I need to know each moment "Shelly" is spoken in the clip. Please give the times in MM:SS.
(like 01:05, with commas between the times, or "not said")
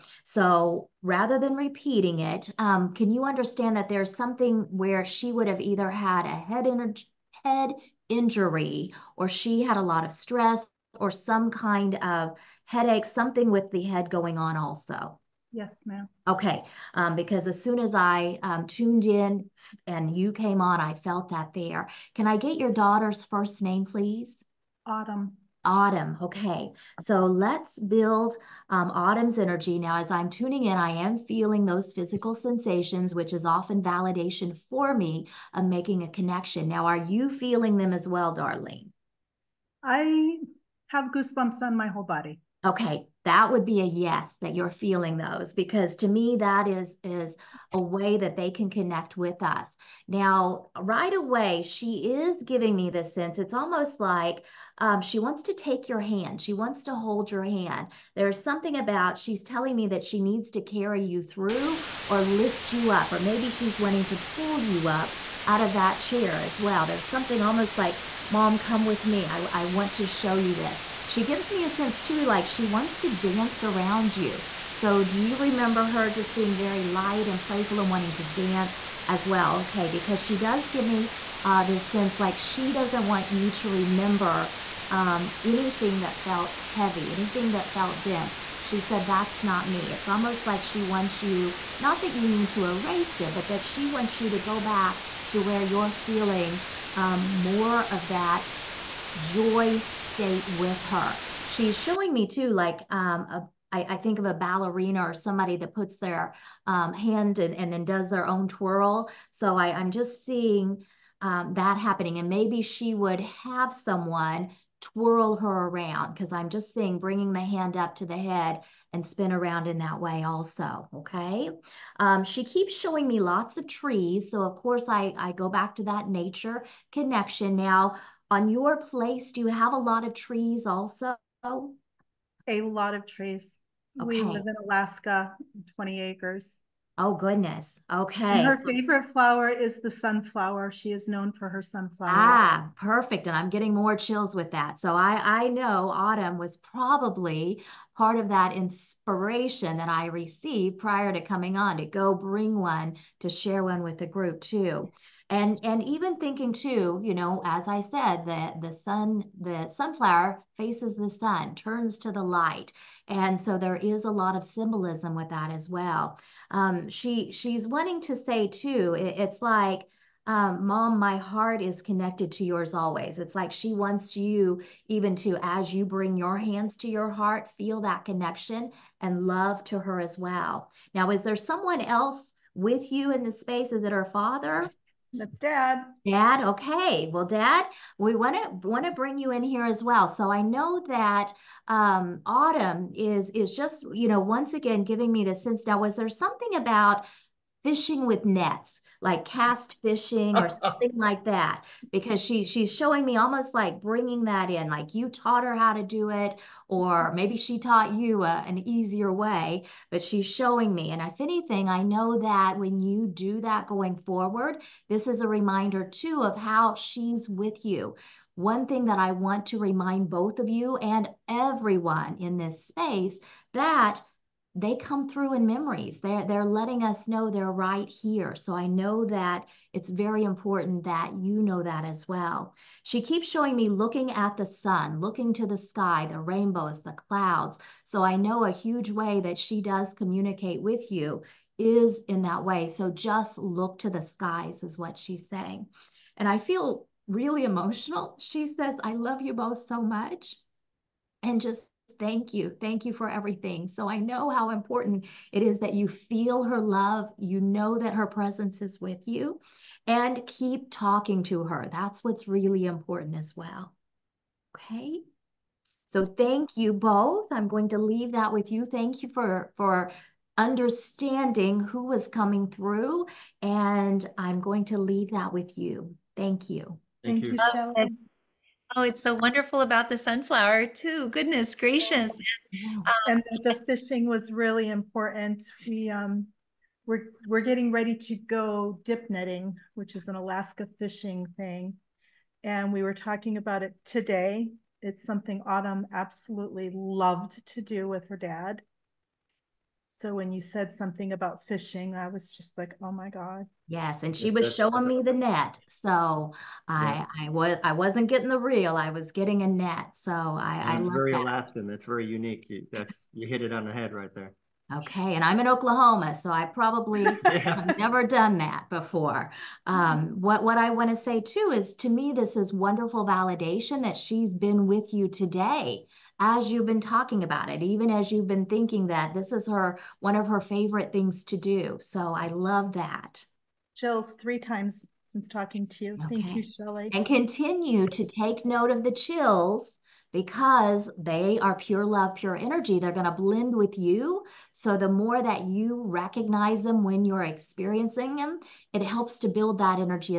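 05:36.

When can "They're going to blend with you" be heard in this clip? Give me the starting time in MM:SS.
05:42.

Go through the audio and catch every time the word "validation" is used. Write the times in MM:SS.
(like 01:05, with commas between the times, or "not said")
00:33, 05:23.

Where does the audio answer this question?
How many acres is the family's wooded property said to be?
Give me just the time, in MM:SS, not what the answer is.
02:15.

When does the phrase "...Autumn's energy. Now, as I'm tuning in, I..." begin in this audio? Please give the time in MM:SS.
00:28.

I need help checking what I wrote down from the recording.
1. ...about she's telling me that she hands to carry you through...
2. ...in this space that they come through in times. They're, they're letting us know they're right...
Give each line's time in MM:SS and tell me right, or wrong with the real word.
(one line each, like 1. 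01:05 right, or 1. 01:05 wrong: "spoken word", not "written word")
1. 00:58 wrong: "needs", not "hands"
2. 03:42 wrong: "memories", not "times".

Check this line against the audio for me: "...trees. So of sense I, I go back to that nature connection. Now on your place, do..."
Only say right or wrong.
wrong.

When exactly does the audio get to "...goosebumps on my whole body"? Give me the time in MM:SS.
00:41.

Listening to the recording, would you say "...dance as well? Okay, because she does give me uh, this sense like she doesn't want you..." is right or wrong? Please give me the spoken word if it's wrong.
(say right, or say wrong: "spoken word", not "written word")
right.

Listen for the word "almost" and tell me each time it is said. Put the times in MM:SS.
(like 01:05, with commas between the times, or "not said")
00:53, 01:07, 01:30, 03:23.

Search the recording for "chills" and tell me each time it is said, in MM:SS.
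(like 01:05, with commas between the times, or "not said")
02:23, 05:38.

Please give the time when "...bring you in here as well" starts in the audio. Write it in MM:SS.
03:08.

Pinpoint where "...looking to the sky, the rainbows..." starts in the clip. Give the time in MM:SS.
03:55.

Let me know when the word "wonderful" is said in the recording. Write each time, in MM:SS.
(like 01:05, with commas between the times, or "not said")
04:39, 05:22.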